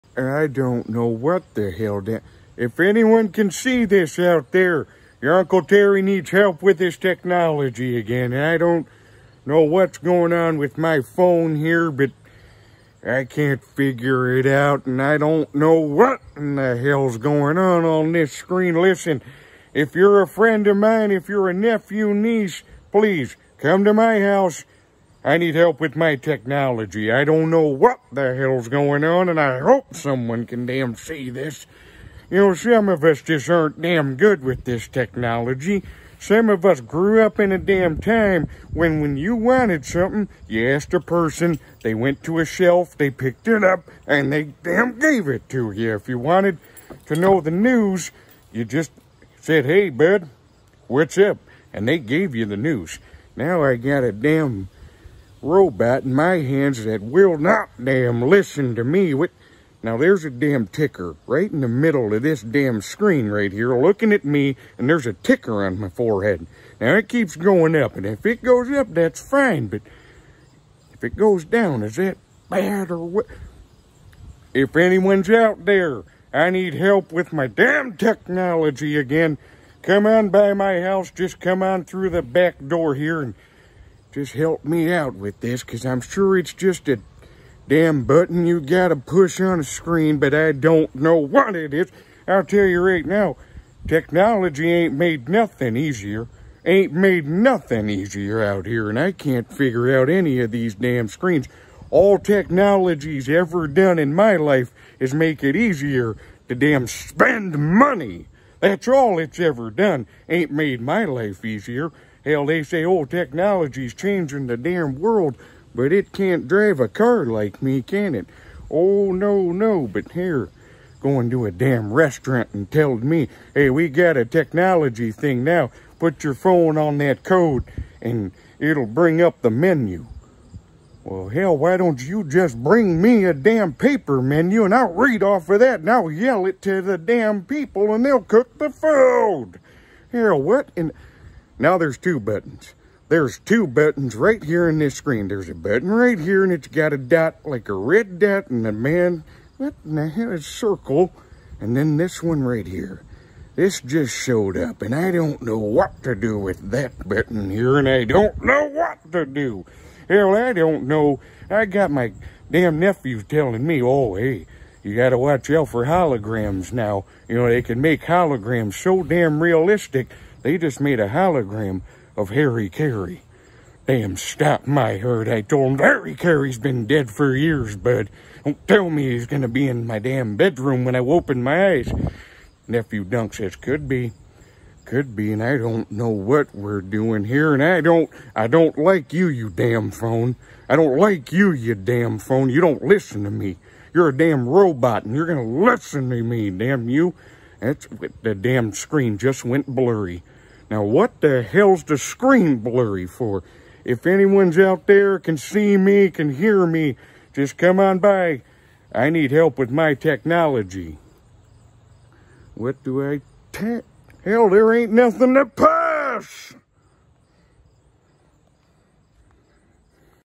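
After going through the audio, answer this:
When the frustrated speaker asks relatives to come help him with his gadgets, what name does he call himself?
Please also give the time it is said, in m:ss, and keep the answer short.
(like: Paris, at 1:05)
Uncle Terry, at 0:05.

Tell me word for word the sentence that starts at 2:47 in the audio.
You know, they can make holograms so damn realistic they just made a hologram of Harry Caray.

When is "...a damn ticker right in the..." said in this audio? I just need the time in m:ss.
1:00.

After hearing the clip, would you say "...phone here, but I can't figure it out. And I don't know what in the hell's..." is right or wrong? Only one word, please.
right.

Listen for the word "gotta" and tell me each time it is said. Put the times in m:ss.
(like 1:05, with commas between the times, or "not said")
1:28.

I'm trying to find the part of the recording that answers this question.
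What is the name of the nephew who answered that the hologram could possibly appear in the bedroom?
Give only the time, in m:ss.
3:03.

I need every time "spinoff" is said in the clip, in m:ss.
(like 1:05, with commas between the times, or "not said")
not said.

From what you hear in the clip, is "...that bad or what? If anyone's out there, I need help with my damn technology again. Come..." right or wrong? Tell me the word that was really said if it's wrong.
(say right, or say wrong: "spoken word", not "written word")
right.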